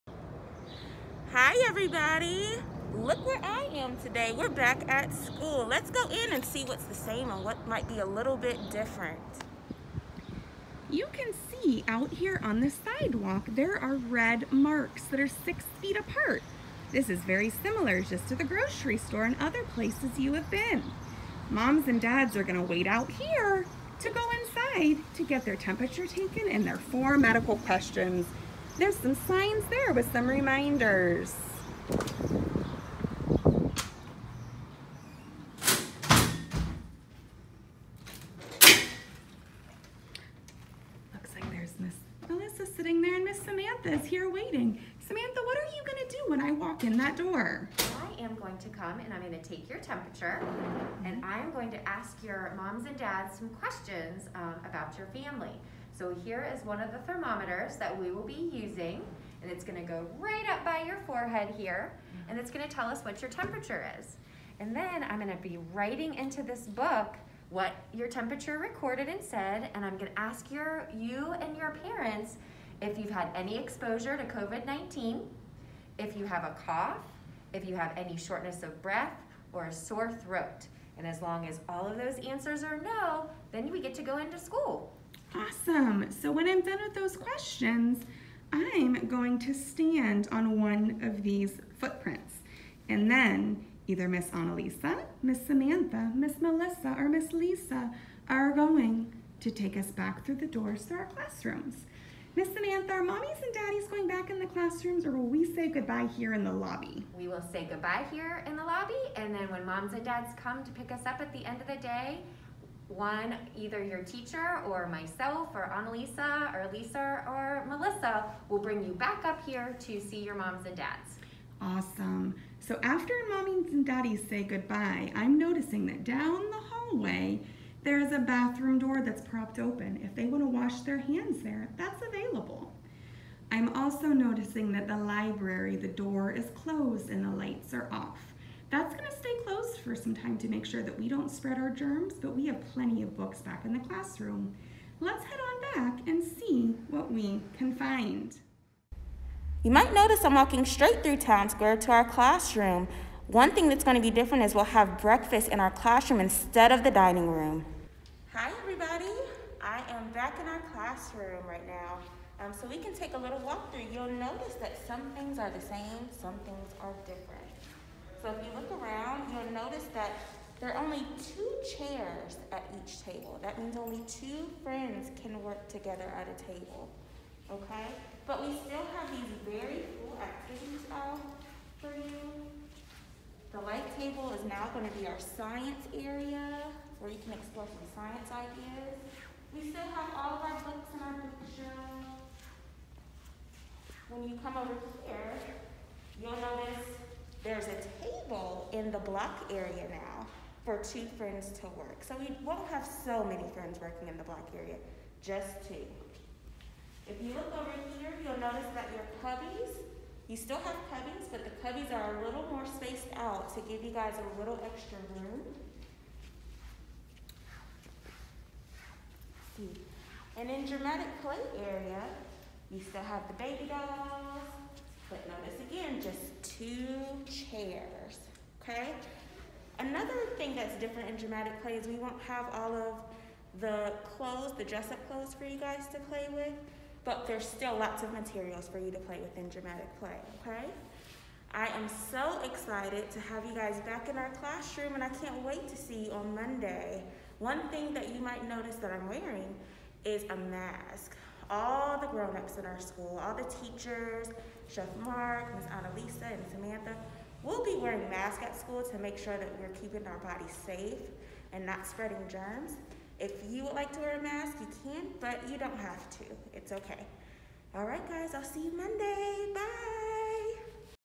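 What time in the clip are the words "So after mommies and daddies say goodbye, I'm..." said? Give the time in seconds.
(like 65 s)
122 s.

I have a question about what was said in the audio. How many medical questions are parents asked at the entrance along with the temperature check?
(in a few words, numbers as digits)
4.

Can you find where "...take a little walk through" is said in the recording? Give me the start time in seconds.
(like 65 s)
162 s.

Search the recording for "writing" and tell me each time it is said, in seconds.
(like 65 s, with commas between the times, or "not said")
65 s.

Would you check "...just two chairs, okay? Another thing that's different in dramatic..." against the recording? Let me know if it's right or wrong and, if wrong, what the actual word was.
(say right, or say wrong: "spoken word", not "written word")
right.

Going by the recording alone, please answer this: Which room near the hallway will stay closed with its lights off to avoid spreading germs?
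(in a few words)
The library.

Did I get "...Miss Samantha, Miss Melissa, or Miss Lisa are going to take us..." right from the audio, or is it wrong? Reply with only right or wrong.
right.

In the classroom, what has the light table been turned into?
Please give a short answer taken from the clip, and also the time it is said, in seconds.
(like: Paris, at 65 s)
Science area, at 185 s.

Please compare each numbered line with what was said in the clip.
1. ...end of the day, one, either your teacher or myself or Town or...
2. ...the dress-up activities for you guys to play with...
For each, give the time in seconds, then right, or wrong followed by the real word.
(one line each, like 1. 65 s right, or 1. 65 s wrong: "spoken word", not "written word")
1. 111 s wrong: "Annalisa", not "Town"
2. 234 s wrong: "clothes", not "activities".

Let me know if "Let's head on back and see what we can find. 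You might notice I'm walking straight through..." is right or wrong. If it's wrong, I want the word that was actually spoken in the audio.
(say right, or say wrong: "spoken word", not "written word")
right.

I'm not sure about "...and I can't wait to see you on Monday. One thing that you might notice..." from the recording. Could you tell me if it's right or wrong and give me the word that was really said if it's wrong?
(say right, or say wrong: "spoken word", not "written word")
right.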